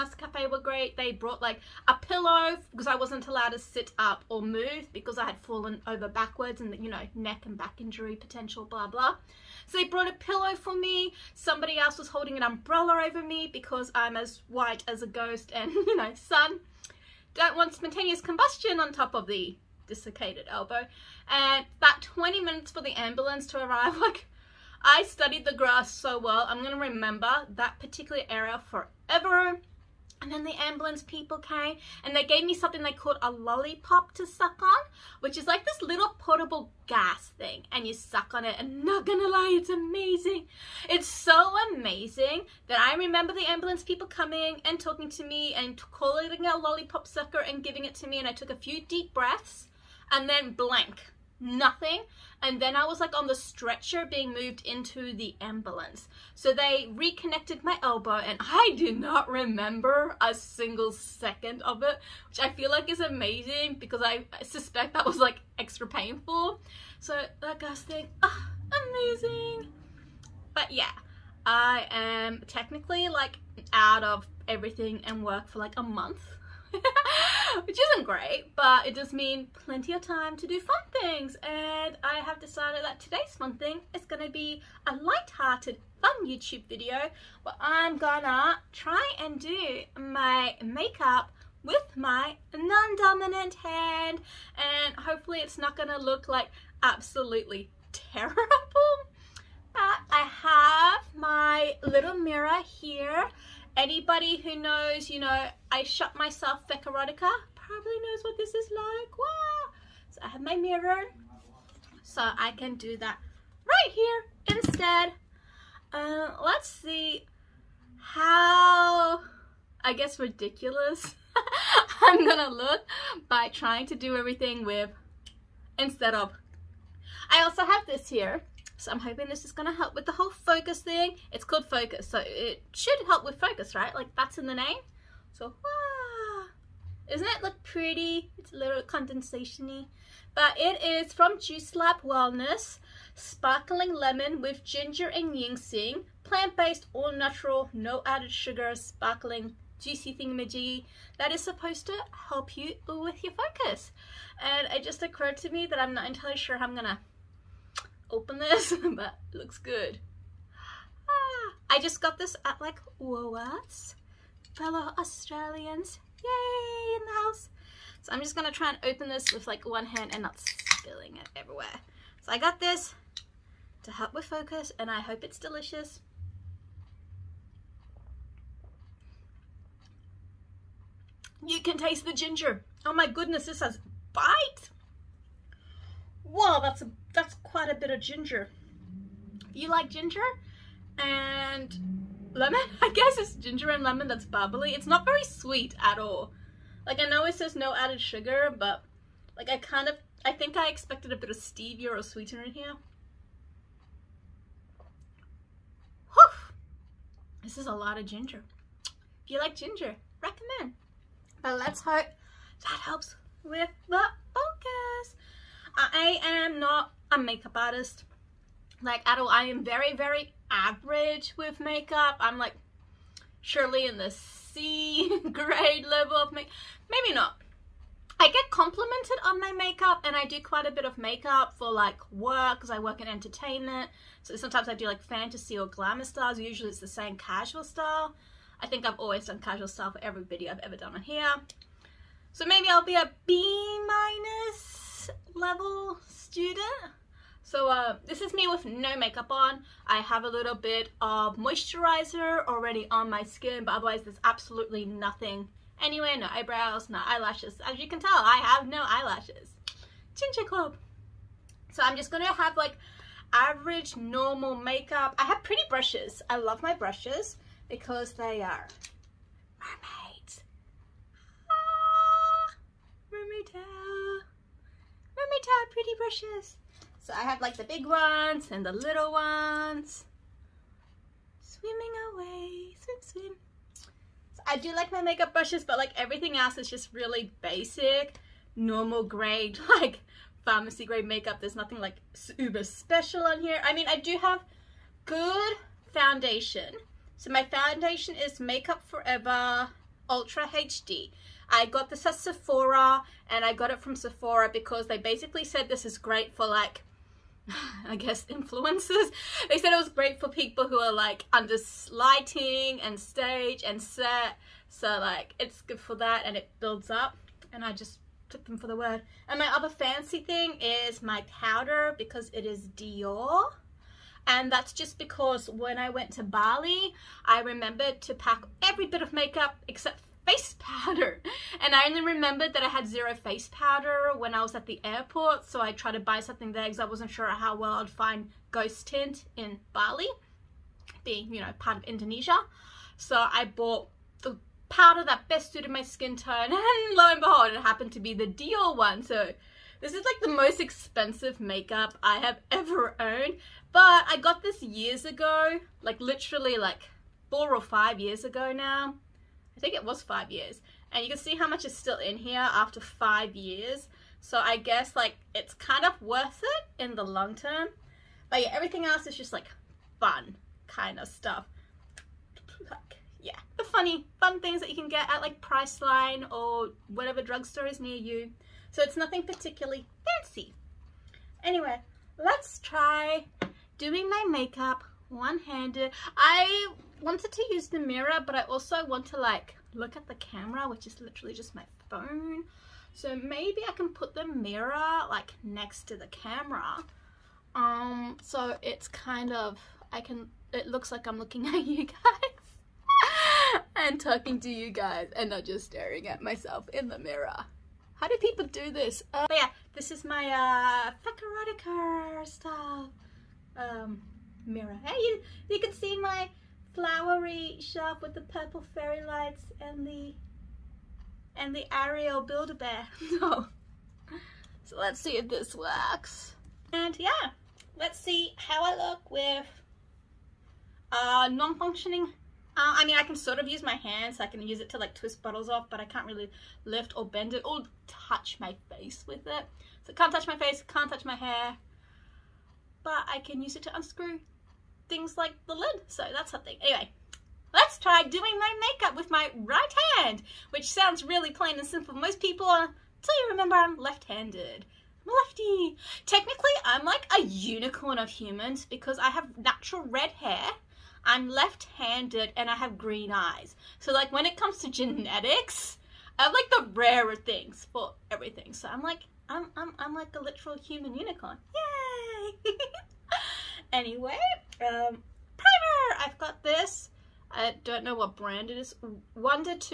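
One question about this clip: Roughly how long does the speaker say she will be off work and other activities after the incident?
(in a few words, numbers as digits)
a month.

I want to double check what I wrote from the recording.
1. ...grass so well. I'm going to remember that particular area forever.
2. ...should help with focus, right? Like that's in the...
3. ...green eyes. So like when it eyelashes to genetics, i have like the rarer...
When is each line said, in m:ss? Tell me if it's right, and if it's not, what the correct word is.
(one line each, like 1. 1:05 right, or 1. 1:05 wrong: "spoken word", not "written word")
1. 0:25 right
2. 2:12 right
3. 7:42 wrong: "comes", not "eyelashes".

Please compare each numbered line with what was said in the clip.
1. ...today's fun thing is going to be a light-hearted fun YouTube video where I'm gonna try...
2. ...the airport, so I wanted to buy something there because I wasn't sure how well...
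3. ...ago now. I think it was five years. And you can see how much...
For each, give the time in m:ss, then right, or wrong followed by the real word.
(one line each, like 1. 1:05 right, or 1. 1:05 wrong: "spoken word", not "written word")
1. 1:22 right
2. 5:34 wrong: "tried", not "wanted"
3. 5:58 right.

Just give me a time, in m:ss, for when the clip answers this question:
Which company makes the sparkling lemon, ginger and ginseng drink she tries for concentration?
2:21.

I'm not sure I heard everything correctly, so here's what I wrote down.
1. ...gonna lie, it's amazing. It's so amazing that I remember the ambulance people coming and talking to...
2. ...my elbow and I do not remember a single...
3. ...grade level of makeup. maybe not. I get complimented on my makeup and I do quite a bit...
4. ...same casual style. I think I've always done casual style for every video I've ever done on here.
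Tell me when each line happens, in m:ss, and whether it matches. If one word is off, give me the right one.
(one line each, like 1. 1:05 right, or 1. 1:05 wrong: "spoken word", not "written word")
1. 0:39 right
2. 0:57 right
3. 3:45 right
4. 3:56 right.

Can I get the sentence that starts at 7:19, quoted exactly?
So can't touch my face, can't touch my hair, but I can use it to unscrew things like the lid.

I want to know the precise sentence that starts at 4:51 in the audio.
There's nothing like uber special on here.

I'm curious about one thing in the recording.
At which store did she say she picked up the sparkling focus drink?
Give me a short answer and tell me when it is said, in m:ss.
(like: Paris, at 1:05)
Woolworths, at 2:43.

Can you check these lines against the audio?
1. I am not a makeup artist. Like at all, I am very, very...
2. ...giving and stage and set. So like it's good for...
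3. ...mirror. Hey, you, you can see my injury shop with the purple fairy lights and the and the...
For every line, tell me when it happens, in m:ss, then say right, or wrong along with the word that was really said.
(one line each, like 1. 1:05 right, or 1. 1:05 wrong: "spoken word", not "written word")
1. 3:35 right
2. 5:11 wrong: "lighting", not "giving"
3. 6:54 wrong: "flowery", not "injury".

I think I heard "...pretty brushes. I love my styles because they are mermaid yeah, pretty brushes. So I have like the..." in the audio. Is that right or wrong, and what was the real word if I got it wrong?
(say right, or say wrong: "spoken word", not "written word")
wrong: "brushes", not "styles".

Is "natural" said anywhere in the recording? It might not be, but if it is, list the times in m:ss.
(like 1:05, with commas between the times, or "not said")
2:27, 7:39.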